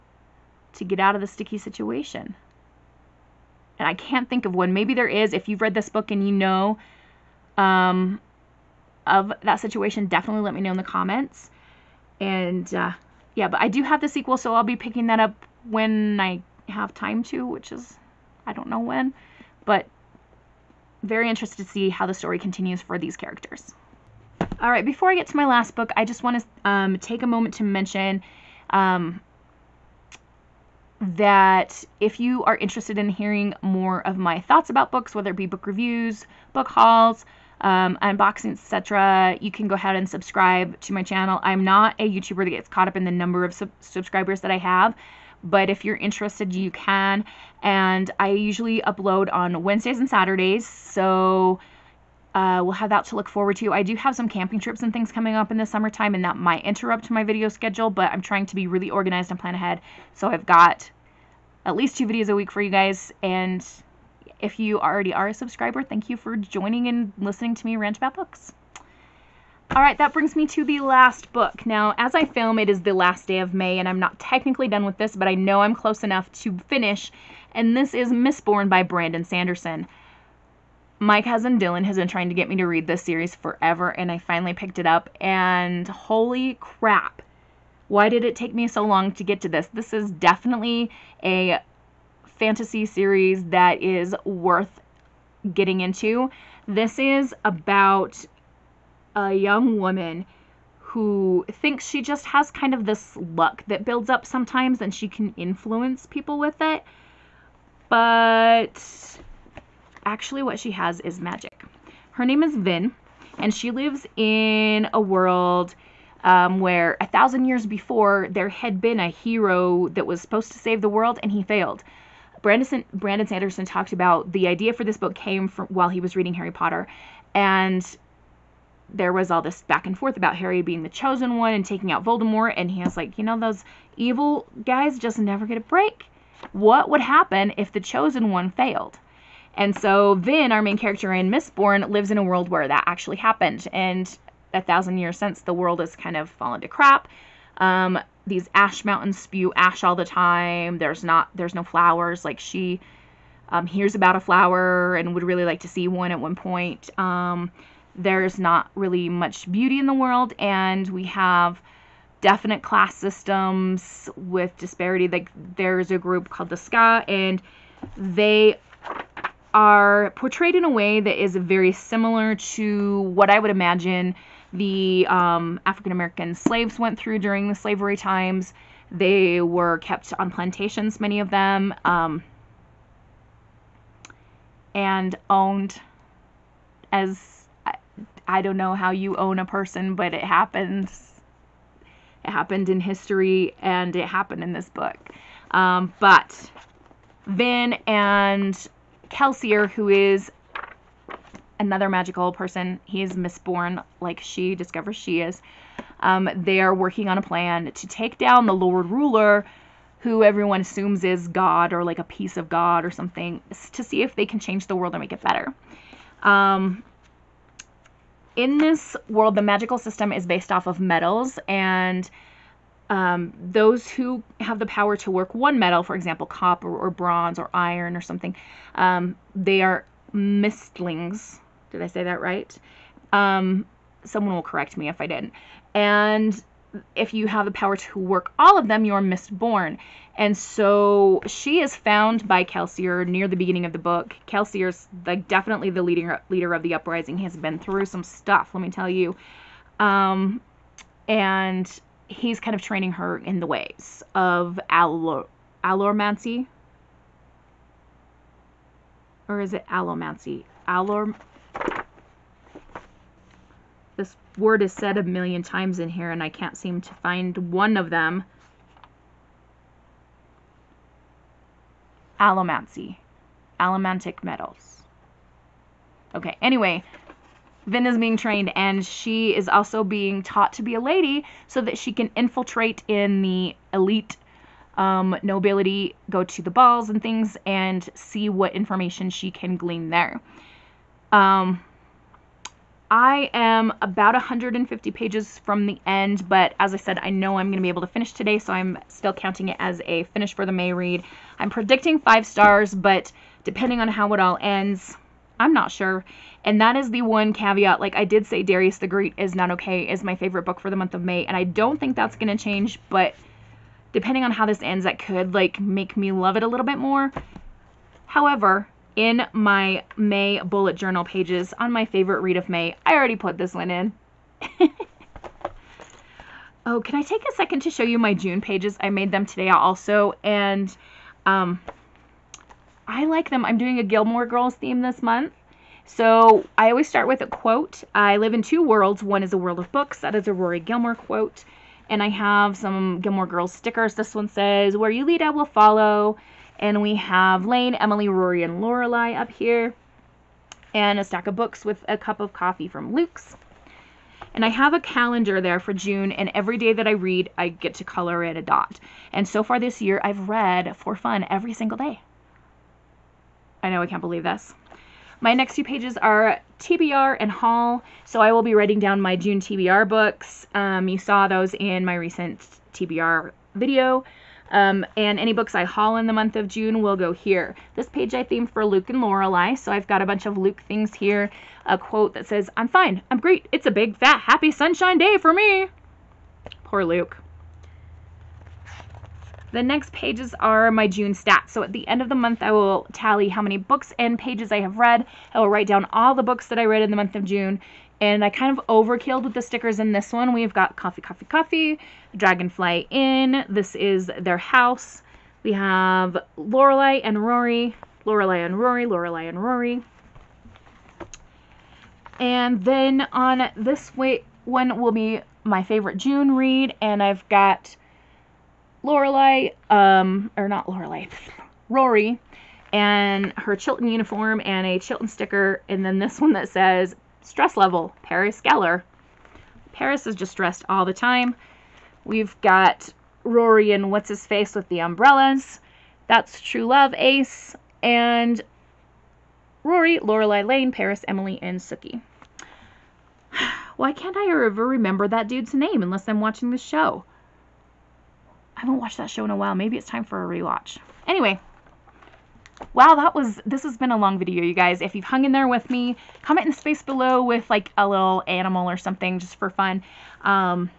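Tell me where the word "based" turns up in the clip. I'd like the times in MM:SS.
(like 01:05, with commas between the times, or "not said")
03:40.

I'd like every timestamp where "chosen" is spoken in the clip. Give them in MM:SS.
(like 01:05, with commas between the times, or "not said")
02:10, 02:17.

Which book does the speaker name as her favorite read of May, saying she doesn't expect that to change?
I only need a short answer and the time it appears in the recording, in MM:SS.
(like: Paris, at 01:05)
Darius the Great Is Not Okay, at 05:08.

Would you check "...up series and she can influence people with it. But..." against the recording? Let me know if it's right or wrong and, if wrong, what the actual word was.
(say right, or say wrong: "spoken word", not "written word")
wrong: "sometimes", not "series".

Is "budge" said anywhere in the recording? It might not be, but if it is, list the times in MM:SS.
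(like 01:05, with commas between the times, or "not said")
not said.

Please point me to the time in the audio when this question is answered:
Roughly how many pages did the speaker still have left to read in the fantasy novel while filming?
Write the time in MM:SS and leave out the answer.
04:54.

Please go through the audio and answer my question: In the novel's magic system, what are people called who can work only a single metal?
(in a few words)
mistlings.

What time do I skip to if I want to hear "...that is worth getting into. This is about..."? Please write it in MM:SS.
01:33.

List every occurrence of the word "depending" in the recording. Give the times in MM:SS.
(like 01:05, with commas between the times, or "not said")
05:03, 05:13.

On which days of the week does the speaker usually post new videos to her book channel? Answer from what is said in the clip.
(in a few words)
Wednesdays and Saturdays.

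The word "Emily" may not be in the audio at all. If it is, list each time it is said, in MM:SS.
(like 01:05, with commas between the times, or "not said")
05:47, 07:21.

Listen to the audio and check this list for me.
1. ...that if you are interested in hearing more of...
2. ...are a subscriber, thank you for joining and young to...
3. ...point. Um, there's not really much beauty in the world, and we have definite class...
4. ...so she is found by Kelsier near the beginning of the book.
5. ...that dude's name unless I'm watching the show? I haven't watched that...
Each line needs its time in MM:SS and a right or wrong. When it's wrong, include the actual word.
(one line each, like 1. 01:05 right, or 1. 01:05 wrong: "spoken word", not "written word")
1. 00:31 right
2. 01:05 wrong: "listening", not "young"
3. 02:36 right
4. 04:00 right
5. 07:25 right.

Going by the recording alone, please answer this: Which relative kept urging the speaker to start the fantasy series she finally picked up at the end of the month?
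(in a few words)
Dylan.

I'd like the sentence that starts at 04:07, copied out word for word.
He has been through some stuff, let me tell you.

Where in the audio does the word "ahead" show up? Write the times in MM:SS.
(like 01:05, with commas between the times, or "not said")
00:39, 00:59.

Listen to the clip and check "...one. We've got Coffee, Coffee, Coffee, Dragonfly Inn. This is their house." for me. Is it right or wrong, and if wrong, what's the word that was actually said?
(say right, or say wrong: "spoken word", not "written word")
right.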